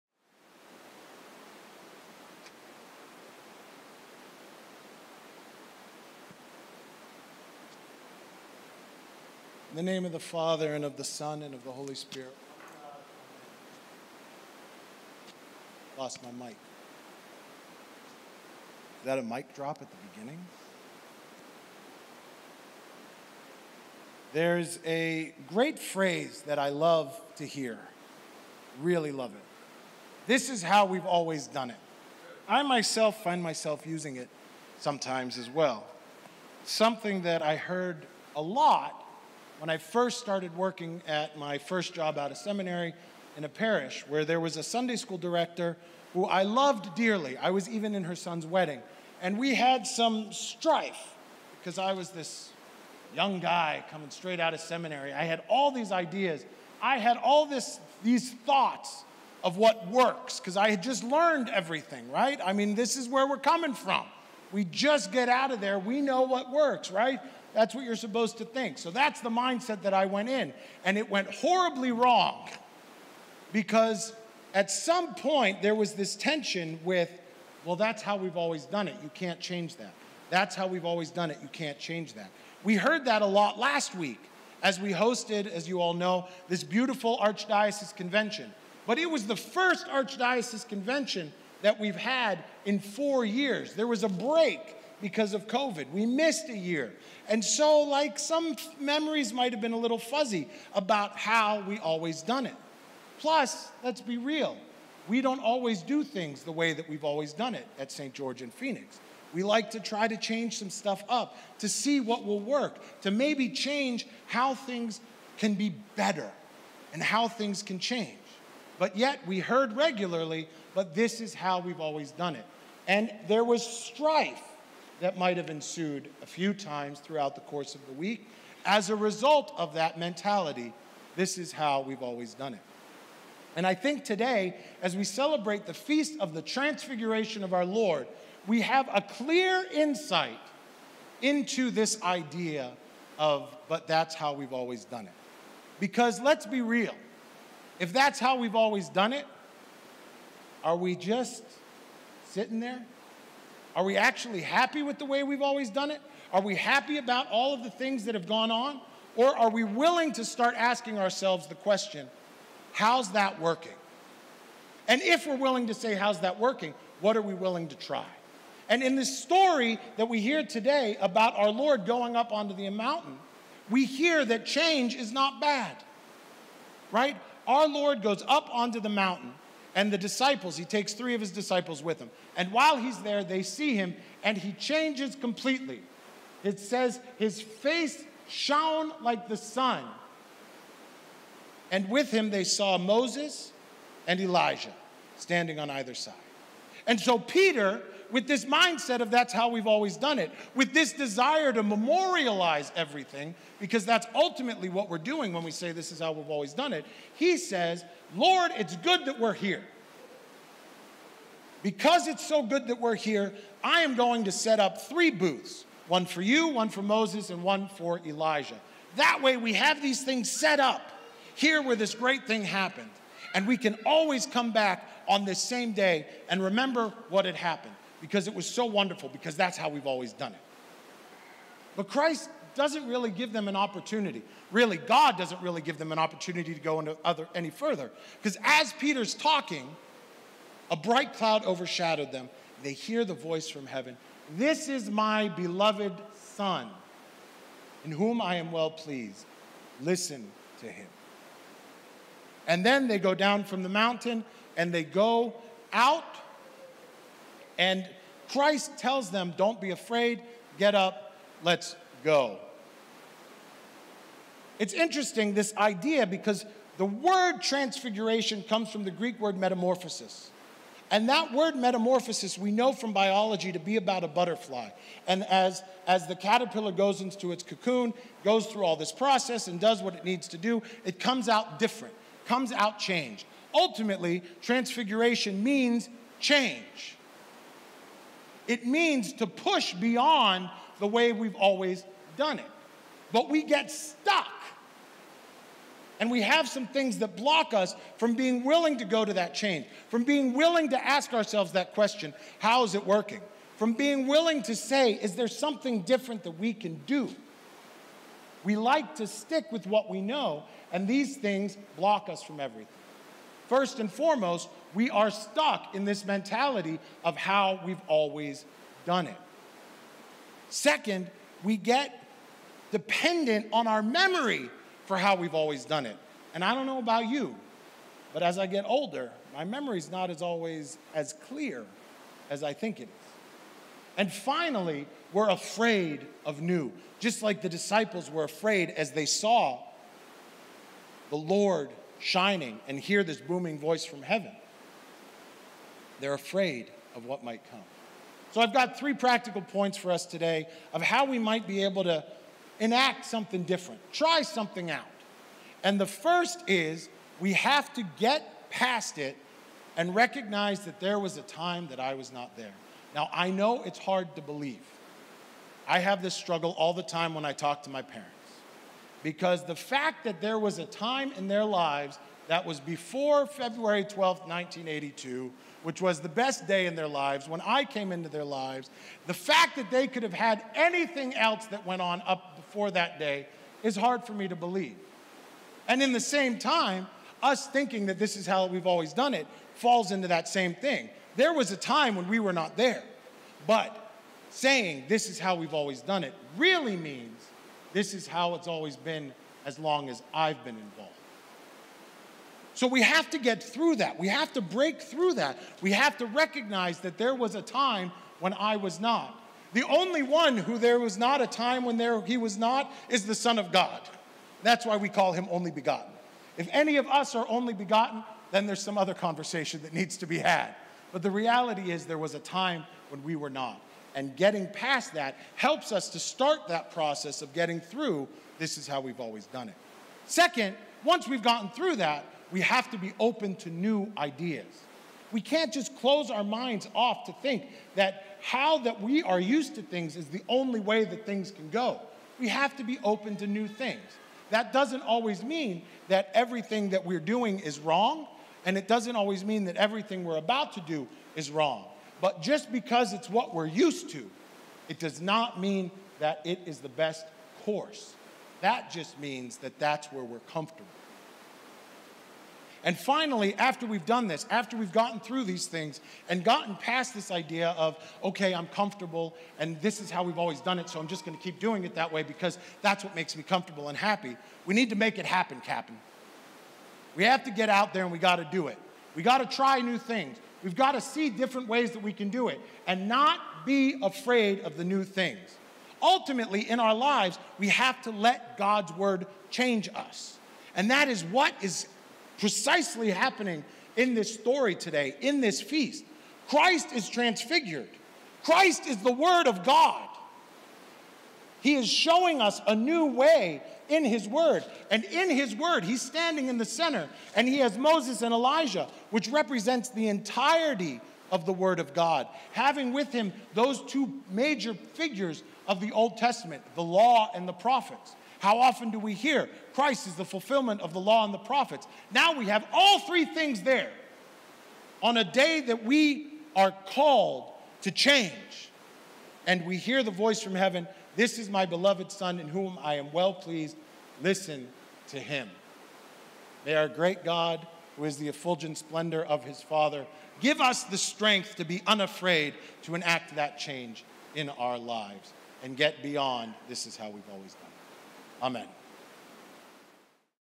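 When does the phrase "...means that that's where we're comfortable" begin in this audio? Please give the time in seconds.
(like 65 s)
458 s.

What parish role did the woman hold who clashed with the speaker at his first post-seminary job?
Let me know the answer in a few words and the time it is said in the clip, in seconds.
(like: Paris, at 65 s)
Sunday school director, at 44 s.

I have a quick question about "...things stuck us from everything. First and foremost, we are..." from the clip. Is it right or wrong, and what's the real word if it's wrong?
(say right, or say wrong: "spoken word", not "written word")
wrong: "block", not "stuck".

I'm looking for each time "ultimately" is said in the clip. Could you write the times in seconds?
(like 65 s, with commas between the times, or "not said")
204 s, 283 s, 485 s.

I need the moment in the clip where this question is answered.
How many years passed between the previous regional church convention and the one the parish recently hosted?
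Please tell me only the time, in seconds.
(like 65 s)
92 s.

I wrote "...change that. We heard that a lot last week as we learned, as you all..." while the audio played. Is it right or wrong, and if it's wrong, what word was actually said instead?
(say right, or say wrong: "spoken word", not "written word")
wrong: "hosted", not "learned".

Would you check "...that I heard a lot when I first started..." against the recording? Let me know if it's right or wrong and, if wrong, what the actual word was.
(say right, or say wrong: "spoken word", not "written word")
right.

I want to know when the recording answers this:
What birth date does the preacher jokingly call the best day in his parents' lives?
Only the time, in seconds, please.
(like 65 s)
373 s.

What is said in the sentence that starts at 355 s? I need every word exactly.
And the first is we have to get past it and recognize that there was a time that I was not there.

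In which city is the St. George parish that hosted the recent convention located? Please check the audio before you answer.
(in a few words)
Phoenix.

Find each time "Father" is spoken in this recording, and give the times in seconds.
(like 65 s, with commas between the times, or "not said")
10 s, 539 s.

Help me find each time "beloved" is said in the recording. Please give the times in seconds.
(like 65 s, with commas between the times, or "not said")
245 s, 531 s.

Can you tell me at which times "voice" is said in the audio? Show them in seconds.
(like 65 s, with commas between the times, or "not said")
243 s, 343 s, 529 s.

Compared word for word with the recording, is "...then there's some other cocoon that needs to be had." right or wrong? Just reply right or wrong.
wrong.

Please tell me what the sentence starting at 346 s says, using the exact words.
They're afraid of what might come.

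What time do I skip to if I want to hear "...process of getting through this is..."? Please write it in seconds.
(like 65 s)
426 s.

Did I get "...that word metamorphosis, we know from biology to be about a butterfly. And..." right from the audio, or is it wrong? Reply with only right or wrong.
right.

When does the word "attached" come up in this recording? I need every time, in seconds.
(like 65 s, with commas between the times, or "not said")
not said.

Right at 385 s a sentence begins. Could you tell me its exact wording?
And in the same time, us thinking that this is how we've always done it falls into that same thing.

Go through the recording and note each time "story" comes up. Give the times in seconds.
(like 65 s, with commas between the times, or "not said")
169 s, 494 s.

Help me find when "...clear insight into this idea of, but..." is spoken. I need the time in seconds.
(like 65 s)
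139 s.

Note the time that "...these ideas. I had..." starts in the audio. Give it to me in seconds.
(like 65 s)
55 s.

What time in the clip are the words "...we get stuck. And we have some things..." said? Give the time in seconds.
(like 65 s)
293 s.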